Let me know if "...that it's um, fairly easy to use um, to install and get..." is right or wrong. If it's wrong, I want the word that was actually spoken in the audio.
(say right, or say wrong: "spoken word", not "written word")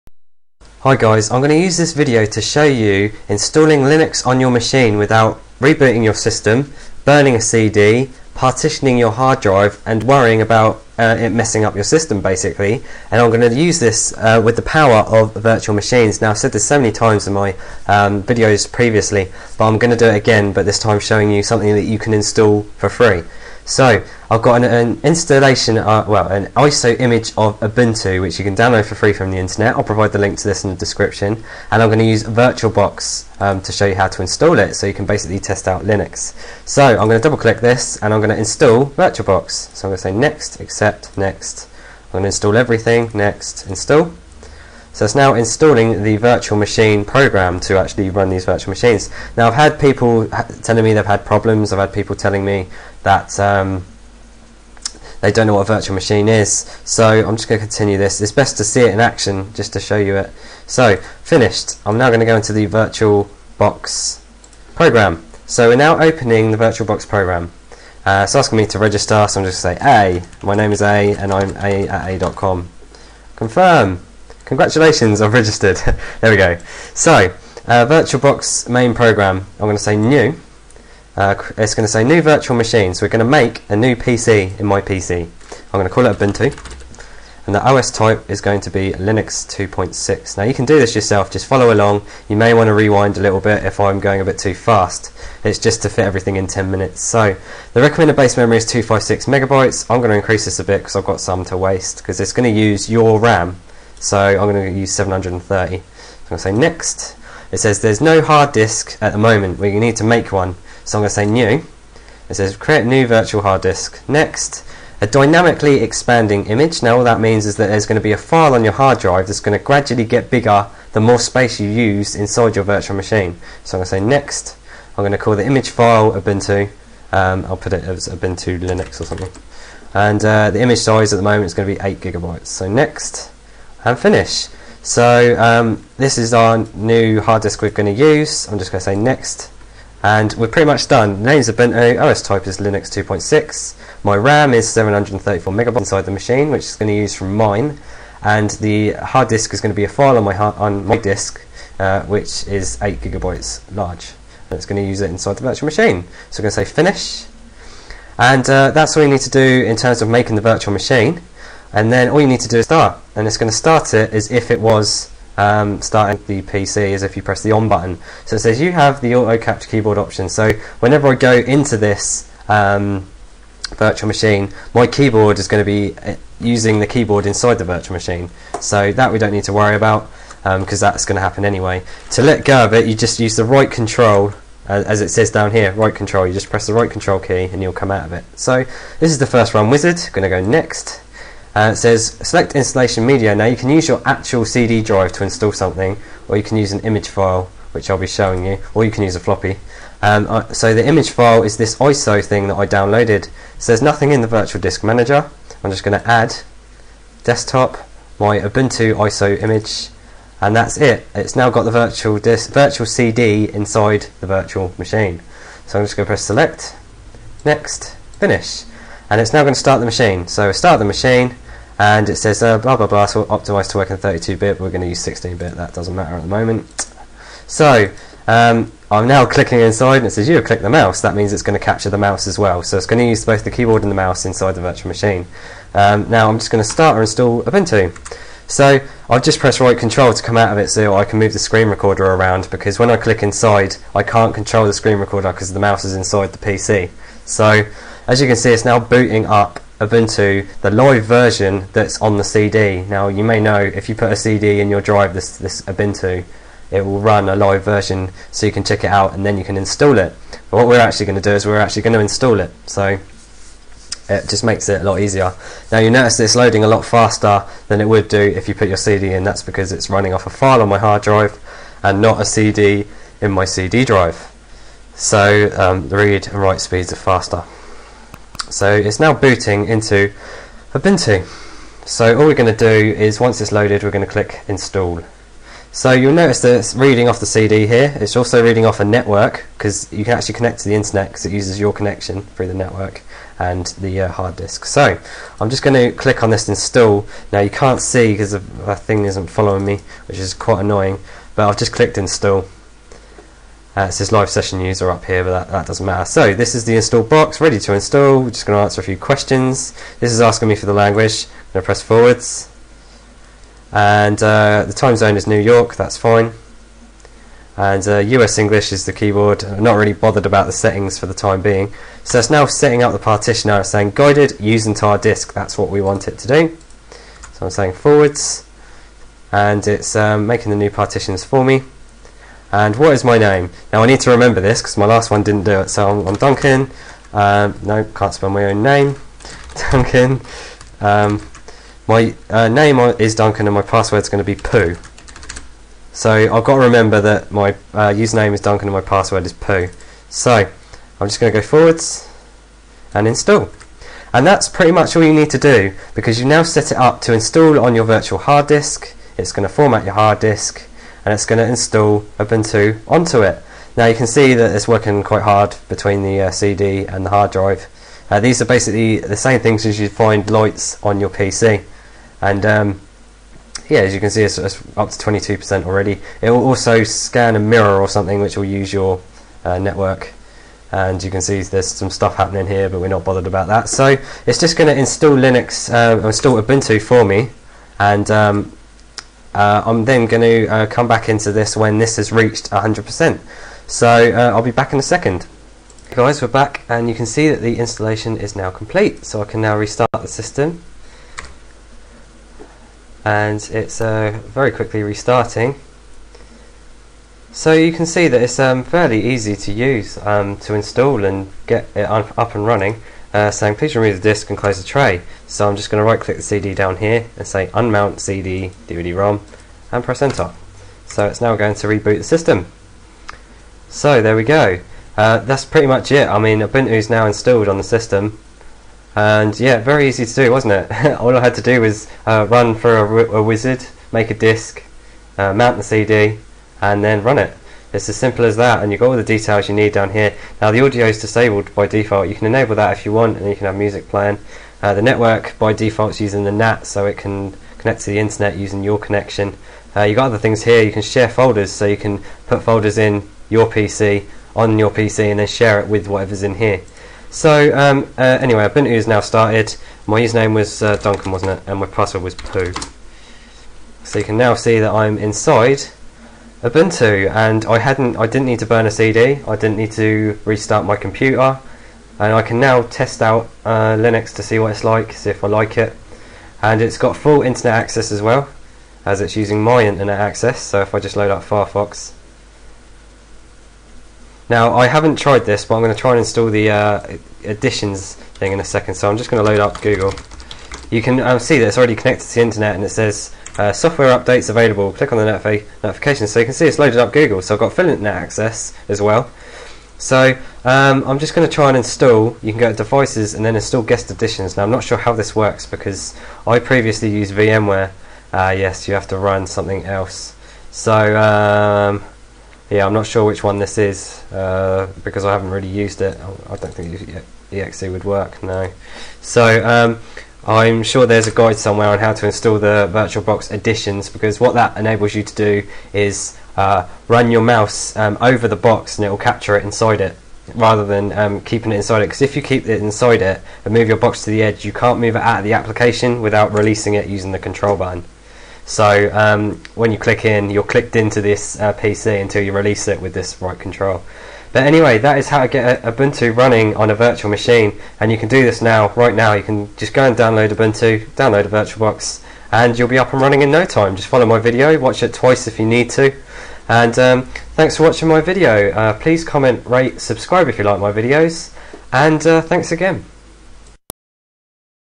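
right.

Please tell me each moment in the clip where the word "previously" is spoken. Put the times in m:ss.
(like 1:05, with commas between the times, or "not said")
0:18, 8:26.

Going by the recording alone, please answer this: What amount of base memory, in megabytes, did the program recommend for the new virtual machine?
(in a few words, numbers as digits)
256.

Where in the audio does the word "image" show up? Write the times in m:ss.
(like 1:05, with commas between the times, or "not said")
0:26, 1:56, 2:05, 2:10, 3:16, 3:20, 3:29.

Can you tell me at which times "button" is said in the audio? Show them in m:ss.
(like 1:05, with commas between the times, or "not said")
2:47, 8:57.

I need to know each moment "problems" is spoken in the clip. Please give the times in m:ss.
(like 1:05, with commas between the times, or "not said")
0:51.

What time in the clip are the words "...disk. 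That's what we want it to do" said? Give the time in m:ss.
5:24.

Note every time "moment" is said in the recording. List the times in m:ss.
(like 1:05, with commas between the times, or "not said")
1:49, 2:11, 3:46.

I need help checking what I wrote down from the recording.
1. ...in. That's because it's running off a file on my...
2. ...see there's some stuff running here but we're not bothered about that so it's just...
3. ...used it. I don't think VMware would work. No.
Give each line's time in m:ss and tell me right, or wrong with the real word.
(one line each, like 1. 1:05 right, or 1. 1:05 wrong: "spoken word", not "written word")
1. 4:29 right
2. 6:21 wrong: "happening", not "running"
3. 8:35 wrong: "EXE", not "VMware".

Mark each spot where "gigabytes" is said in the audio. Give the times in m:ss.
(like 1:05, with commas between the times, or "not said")
2:11, 2:32.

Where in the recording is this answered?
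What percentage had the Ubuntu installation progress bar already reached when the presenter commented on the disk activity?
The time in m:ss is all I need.
6:14.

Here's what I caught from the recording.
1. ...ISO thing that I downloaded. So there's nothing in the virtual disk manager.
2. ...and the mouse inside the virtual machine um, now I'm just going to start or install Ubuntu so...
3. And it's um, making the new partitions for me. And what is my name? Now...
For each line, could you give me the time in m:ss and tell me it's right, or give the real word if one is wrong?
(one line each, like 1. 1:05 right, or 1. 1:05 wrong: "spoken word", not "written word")
1. 3:21 right
2. 3:53 right
3. 5:29 right.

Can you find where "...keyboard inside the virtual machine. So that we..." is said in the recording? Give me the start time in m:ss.
2:56.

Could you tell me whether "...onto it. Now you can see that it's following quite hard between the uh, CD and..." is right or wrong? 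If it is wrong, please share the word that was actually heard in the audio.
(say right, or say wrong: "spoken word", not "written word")
wrong: "working", not "following".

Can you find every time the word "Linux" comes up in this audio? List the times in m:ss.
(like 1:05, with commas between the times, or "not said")
0:03, 0:35, 1:28, 2:08, 2:22, 6:25, 7:53.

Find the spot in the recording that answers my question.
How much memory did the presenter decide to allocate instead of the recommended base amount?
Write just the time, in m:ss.
1:44.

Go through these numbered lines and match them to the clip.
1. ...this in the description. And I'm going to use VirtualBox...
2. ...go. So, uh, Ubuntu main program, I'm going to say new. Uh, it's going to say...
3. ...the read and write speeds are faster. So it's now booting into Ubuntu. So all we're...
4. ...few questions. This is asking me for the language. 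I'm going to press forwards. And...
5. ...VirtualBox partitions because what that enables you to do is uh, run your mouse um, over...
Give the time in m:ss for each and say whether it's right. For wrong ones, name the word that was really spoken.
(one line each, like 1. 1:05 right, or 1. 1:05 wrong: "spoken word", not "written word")
1. 0:30 right
2. 1:16 wrong: "VirtualBox", not "Ubuntu"
3. 4:35 right
4. 5:08 right
5. 8:42 wrong: "additions", not "partitions".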